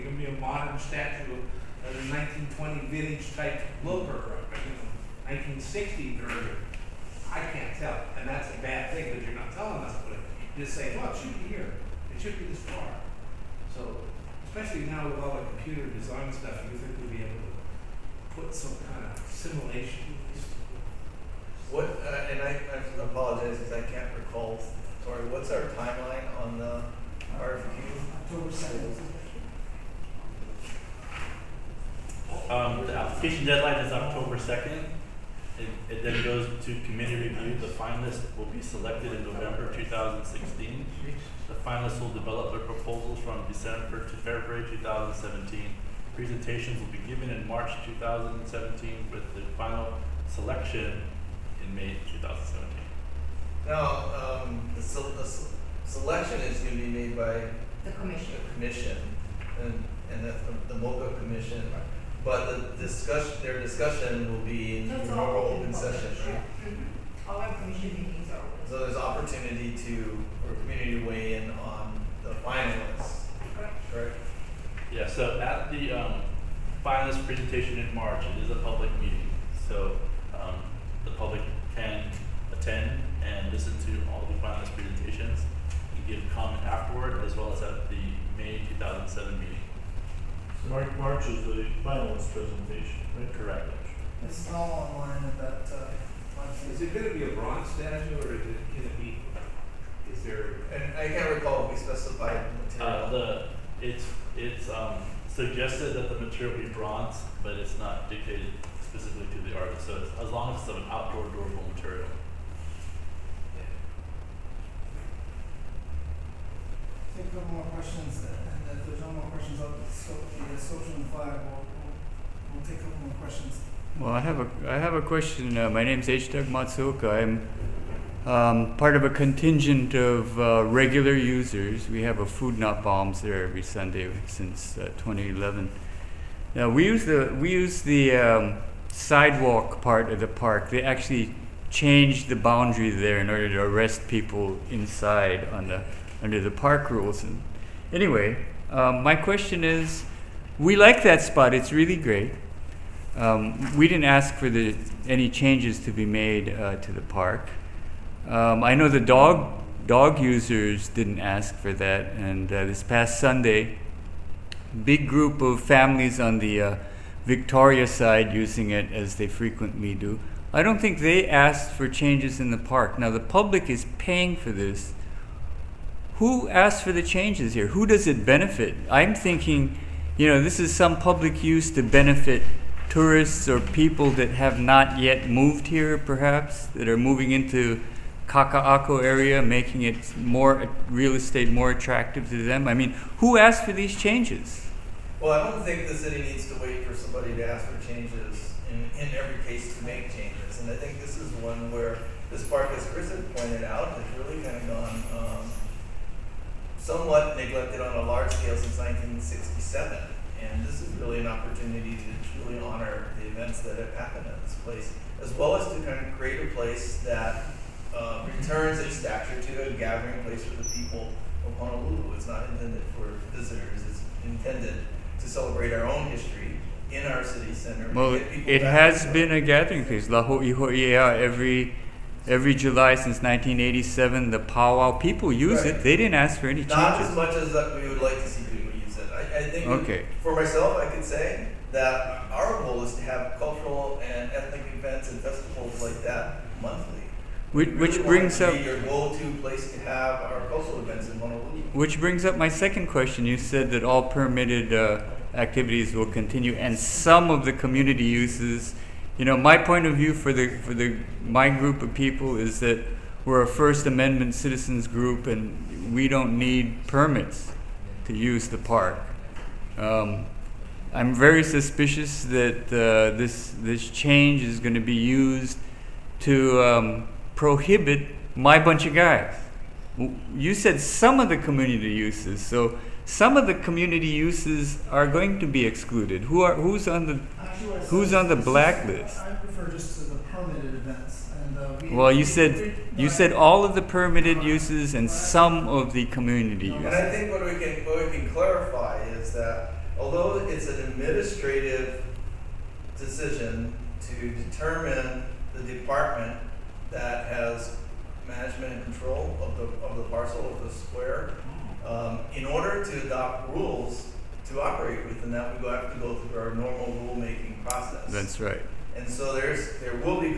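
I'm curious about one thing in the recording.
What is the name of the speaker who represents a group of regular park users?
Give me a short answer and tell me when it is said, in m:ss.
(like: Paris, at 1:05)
H. Doug Matsuoka, at 2:06.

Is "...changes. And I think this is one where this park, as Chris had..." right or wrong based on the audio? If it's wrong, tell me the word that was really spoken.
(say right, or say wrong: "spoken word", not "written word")
right.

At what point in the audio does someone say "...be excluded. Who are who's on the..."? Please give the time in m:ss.
4:45.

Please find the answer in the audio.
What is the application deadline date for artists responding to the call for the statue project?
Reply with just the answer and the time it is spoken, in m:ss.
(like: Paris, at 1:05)
October 2nd, at 0:33.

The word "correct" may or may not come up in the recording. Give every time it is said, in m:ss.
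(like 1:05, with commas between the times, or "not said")
1:13, 1:33.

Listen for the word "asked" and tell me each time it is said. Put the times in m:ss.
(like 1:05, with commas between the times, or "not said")
2:51, 2:56, 3:13.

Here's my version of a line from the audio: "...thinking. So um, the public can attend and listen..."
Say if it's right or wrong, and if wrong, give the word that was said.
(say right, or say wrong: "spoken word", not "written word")
wrong: "meeting", not "thinking".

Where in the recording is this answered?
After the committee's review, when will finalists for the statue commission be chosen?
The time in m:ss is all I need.
0:39.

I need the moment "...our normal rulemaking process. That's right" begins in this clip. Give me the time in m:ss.
5:16.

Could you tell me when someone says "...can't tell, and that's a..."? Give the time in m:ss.
0:07.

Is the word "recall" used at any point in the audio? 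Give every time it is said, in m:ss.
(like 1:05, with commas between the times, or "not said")
0:24, 1:41.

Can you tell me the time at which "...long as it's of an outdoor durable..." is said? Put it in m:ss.
1:50.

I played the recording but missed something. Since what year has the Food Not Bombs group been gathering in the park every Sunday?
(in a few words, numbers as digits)
2011.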